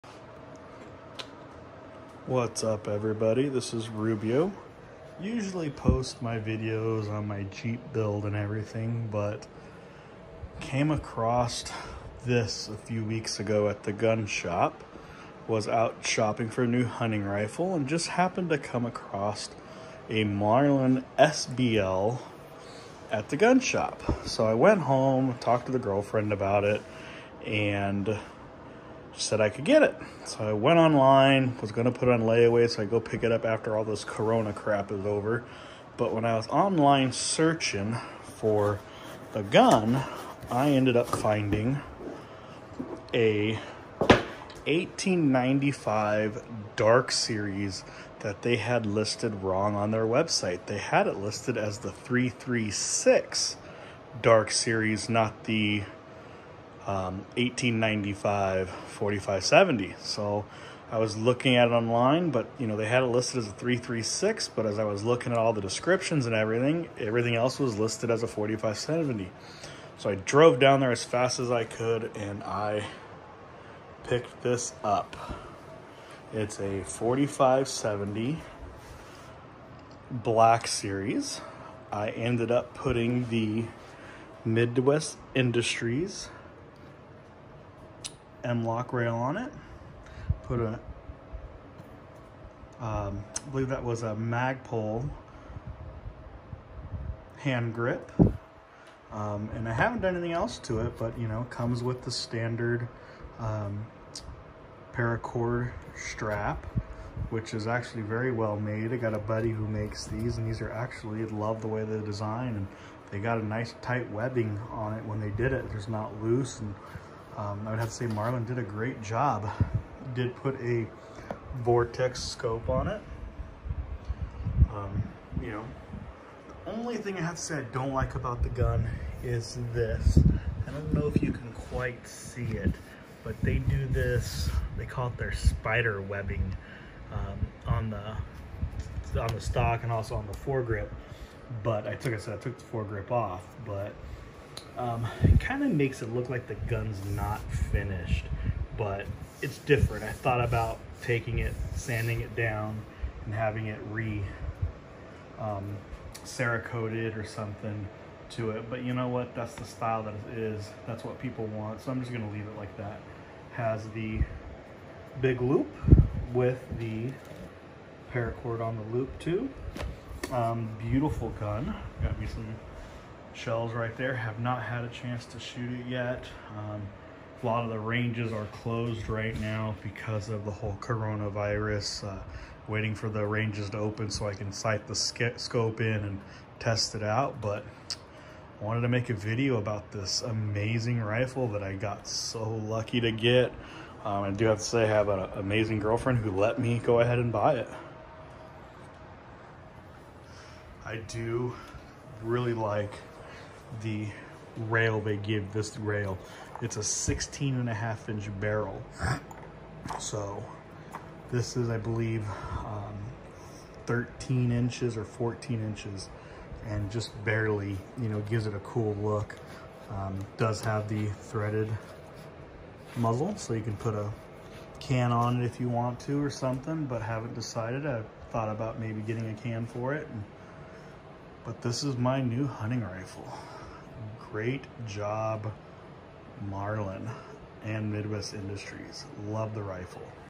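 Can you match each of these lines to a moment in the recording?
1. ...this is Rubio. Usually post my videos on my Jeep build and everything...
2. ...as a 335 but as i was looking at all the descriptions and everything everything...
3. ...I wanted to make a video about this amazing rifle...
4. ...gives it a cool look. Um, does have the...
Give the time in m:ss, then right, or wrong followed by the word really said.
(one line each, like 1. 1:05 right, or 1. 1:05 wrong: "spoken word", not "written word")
1. 0:03 right
2. 1:03 wrong: "336", not "335"
3. 3:08 right
4. 3:38 right.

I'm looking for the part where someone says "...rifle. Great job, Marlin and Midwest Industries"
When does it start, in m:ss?
3:52.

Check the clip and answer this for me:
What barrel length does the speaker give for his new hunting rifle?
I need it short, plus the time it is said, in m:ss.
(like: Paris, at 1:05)
16.5 inches, at 3:26.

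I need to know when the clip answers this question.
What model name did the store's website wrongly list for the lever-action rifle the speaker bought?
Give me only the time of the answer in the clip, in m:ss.
0:51.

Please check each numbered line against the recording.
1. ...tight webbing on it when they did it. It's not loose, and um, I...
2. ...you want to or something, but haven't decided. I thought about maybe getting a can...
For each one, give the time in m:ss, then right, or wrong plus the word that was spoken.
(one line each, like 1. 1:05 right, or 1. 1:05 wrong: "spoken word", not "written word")
1. 1:53 right
2. 3:45 right.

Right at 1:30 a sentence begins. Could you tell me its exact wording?
Put a, um, I believe that was a Magpul hand grip.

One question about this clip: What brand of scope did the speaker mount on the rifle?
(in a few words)
Vortex.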